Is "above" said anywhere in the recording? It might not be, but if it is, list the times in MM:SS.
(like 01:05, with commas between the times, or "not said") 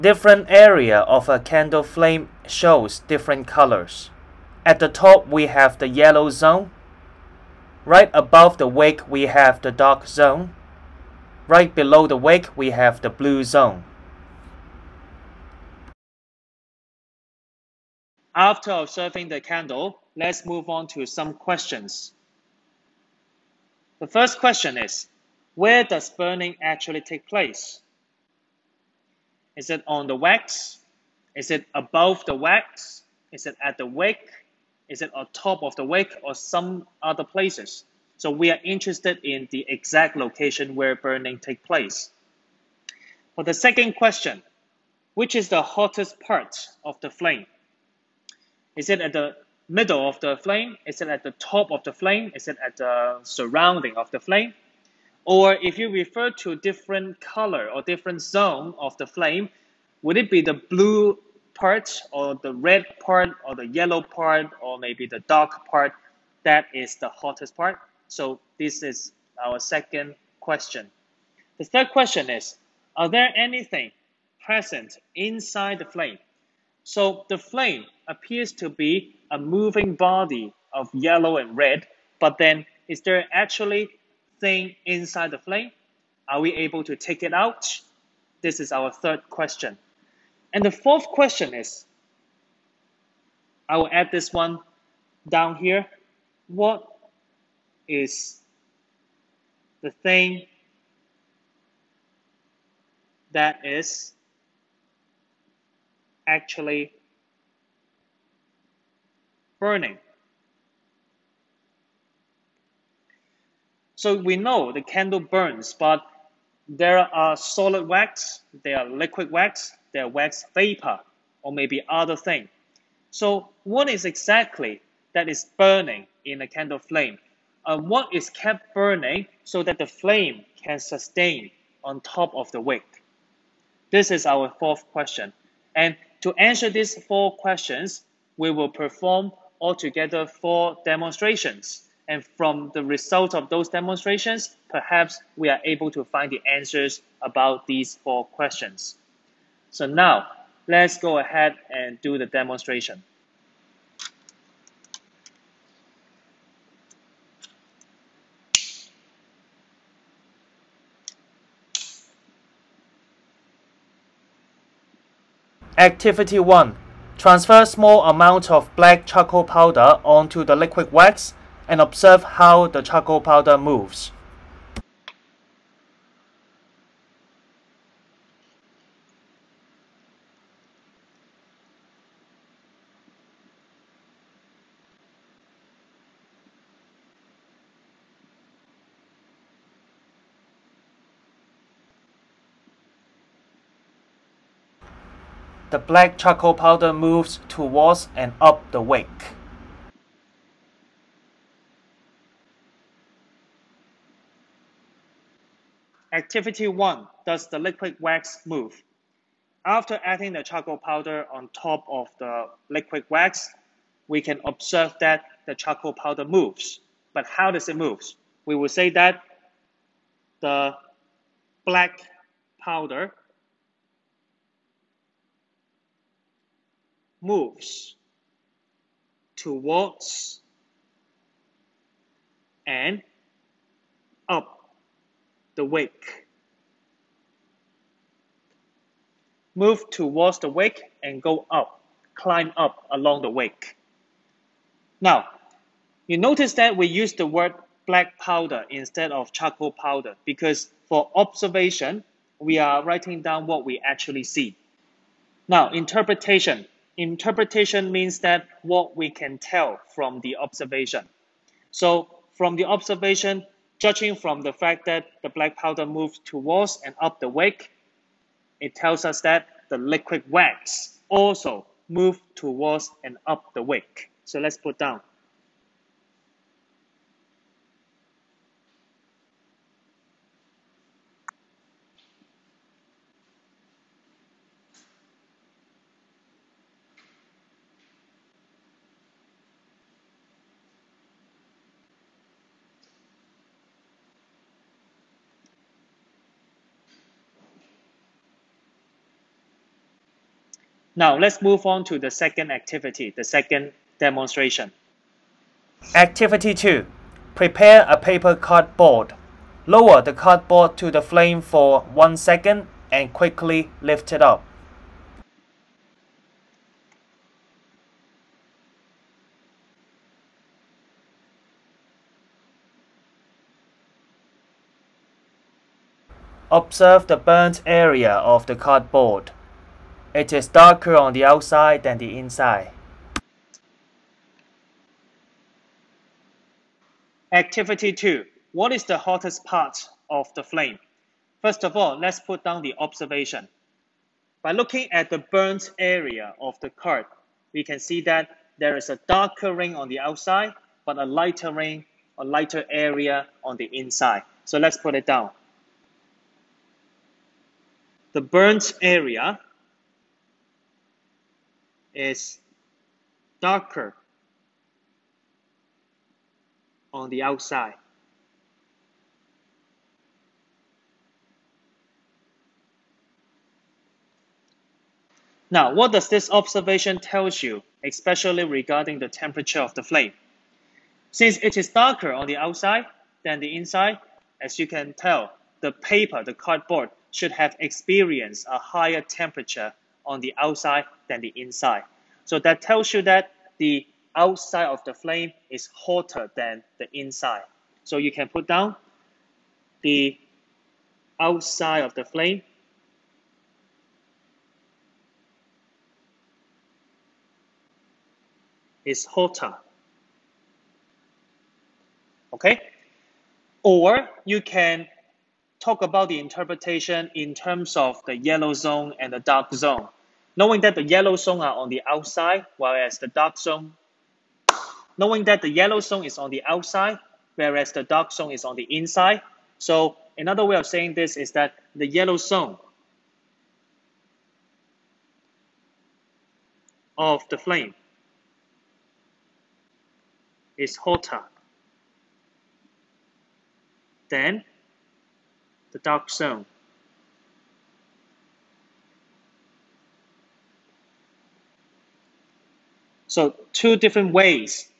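00:08, 00:31.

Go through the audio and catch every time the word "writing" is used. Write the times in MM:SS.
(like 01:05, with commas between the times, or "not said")
04:12.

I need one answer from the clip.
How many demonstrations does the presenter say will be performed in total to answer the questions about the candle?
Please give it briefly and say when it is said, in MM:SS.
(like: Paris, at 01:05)
4, at 02:20.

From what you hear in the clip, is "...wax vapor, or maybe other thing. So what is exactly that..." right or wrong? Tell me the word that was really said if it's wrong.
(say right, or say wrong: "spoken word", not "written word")
right.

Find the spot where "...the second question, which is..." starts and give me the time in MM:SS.
00:43.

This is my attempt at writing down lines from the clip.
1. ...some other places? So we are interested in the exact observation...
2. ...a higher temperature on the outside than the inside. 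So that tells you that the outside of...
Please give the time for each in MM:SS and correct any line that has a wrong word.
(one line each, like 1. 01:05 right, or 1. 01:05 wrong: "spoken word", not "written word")
1. 00:36 wrong: "location", not "observation"
2. 06:28 right.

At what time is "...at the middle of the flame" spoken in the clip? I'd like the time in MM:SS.
00:48.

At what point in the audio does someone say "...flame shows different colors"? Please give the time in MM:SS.
00:01.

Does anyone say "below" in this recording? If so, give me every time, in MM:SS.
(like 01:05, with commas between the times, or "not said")
00:11.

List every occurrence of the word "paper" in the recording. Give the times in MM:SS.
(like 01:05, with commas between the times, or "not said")
05:07, 06:25.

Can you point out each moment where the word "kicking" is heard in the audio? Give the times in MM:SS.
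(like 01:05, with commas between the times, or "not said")
not said.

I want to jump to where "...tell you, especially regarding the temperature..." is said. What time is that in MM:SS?
06:16.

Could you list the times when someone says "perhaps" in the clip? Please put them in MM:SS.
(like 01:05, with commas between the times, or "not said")
02:24.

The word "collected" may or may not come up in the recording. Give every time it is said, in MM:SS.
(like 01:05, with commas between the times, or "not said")
not said.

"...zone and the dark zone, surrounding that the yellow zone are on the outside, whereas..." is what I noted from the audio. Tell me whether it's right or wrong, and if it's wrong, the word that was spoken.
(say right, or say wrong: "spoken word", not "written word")
wrong: "knowing", not "surrounding".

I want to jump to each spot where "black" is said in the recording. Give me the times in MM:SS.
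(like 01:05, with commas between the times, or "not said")
02:48, 03:15, 03:41, 04:07, 04:25.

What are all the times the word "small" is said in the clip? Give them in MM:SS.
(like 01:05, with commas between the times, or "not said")
02:47.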